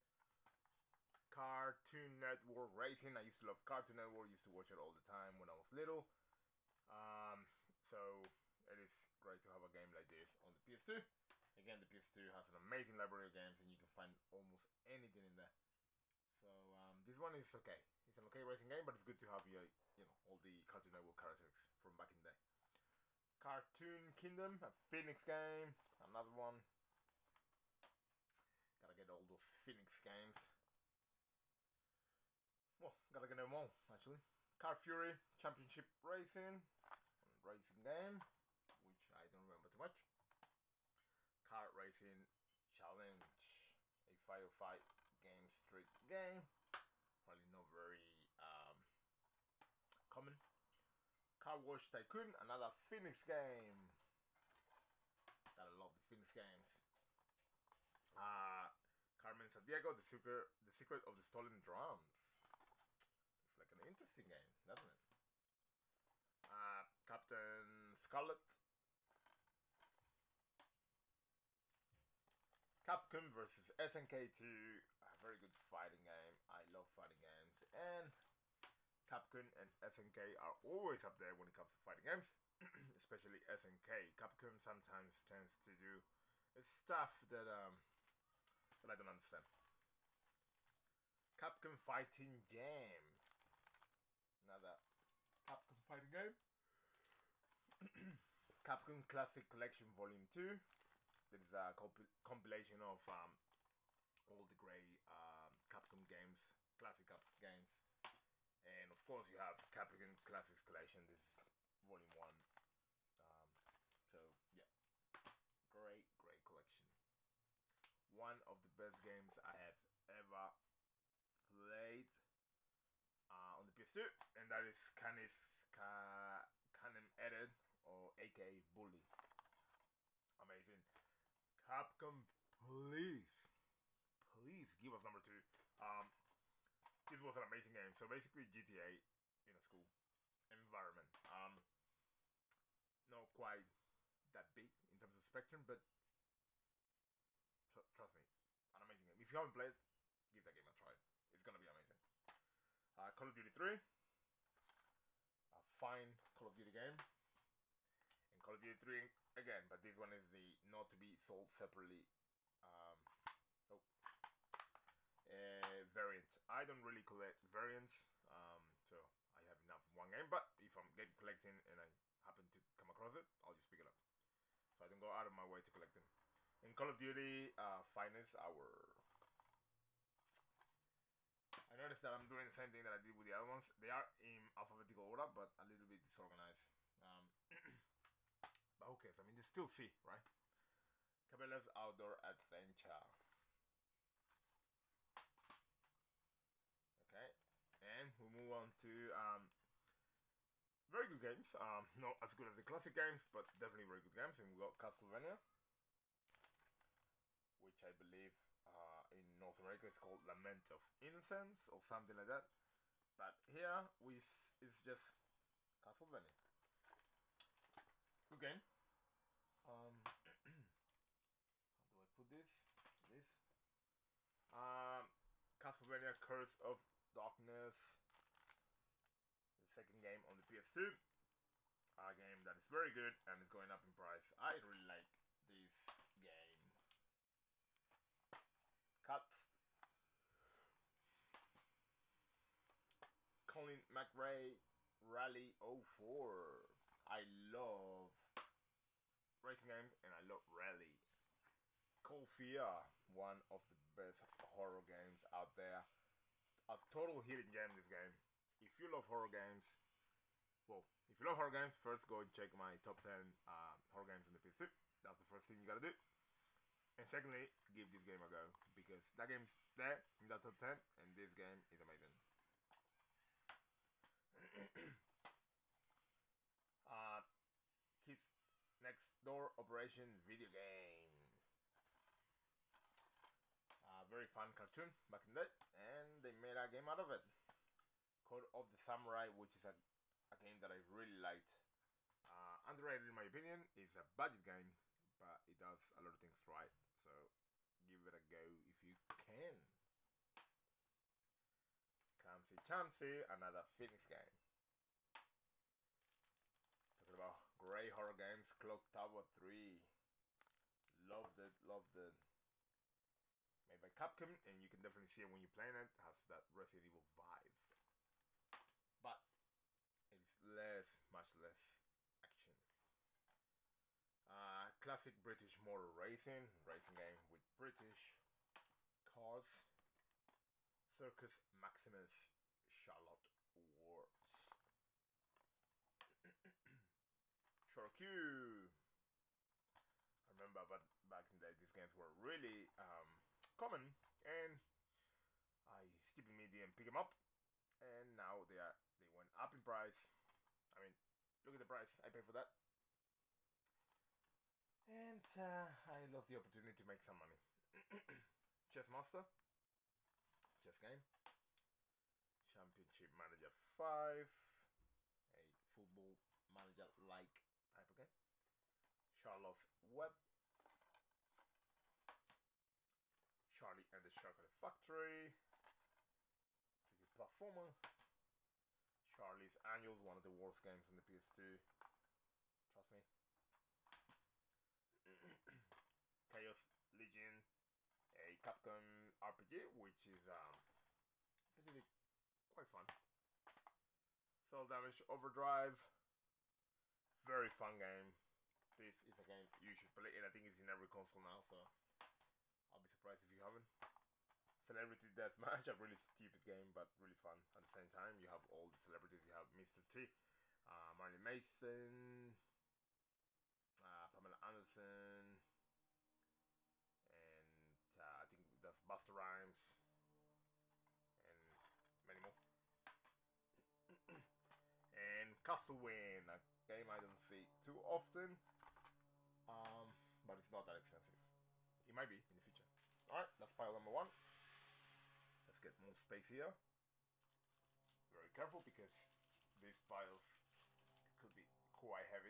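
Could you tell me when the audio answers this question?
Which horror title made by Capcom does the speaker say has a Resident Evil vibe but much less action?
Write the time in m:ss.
5:08.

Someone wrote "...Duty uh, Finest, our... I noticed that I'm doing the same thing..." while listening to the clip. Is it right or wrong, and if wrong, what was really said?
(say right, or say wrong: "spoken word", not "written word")
right.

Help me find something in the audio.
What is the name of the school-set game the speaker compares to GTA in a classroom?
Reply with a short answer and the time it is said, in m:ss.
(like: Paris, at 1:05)
Bully, at 2:08.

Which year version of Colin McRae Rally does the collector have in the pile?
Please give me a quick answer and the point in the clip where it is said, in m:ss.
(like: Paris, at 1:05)
04, at 4:03.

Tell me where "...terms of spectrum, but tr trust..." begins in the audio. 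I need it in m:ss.
2:24.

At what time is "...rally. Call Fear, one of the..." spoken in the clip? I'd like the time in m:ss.
4:10.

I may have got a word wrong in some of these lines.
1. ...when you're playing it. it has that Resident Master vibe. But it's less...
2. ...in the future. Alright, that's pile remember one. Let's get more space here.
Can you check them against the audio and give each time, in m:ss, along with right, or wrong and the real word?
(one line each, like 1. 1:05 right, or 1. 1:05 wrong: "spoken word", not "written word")
1. 5:15 wrong: "Evil", not "Master"
2. 7:12 wrong: "number", not "remember".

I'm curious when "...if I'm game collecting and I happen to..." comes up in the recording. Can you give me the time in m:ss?
2:50.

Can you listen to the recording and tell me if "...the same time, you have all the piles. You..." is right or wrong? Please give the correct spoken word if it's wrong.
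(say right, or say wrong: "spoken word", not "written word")
wrong: "celebrities", not "piles".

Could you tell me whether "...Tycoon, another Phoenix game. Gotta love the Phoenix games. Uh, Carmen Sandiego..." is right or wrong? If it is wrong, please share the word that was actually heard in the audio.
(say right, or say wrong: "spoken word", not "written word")
right.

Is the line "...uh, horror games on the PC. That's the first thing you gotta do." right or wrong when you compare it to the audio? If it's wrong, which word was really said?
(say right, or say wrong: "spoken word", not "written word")
right.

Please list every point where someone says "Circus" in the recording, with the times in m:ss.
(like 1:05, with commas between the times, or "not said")
5:30.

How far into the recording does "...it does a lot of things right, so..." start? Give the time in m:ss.
4:55.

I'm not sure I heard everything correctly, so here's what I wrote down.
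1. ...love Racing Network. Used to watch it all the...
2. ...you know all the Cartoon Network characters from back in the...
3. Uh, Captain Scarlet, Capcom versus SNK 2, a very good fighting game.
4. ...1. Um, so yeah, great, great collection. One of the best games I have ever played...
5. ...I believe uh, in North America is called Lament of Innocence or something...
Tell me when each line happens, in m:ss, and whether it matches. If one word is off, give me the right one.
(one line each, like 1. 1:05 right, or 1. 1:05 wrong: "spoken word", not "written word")
1. 0:03 wrong: "Cartoon", not "Racing"
2. 0:19 right
3. 1:06 right
4. 1:52 right
5. 3:27 right.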